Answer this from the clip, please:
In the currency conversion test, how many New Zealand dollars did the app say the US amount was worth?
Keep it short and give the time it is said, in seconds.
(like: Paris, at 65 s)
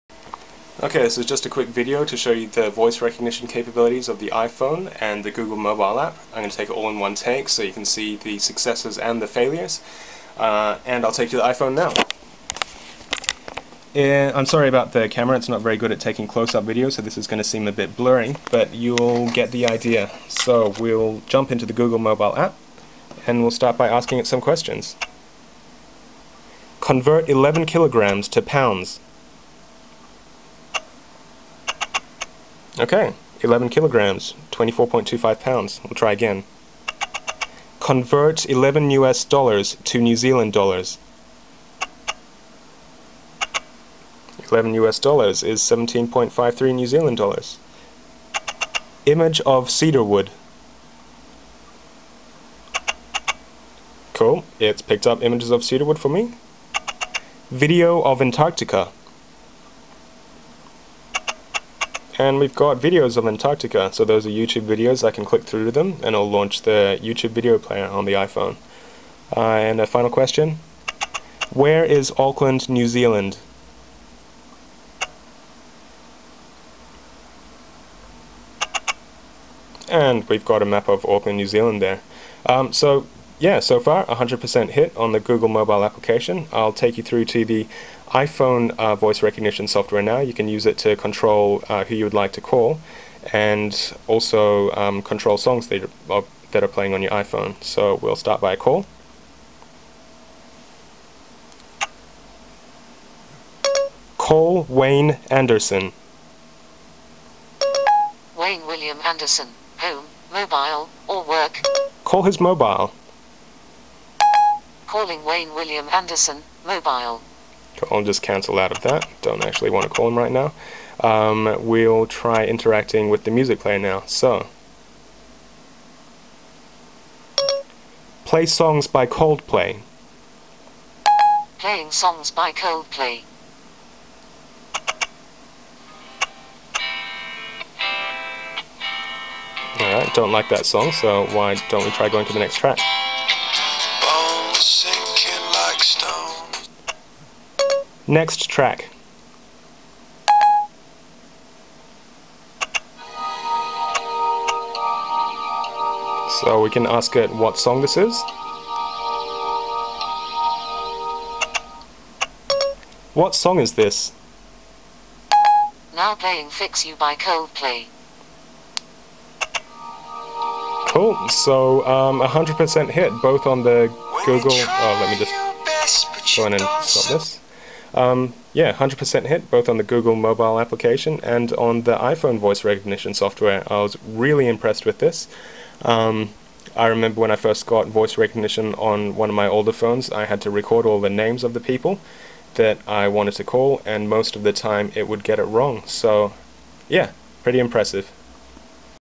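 17.53, at 45 s.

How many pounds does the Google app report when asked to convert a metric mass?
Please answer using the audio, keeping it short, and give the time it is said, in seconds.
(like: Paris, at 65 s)
24.25 pounds, at 34 s.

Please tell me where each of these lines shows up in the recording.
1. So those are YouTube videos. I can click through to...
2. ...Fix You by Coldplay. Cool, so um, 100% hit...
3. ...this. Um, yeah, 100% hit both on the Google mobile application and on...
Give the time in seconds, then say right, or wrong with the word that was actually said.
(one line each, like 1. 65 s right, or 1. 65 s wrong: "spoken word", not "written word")
1. 63 s right
2. 166 s right
3. 177 s right.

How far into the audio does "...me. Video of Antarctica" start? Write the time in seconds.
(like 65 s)
56 s.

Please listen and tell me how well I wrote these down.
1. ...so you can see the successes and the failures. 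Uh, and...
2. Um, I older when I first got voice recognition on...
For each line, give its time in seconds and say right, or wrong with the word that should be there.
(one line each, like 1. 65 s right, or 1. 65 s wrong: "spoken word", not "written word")
1. 7 s right
2. 185 s wrong: "remember", not "older".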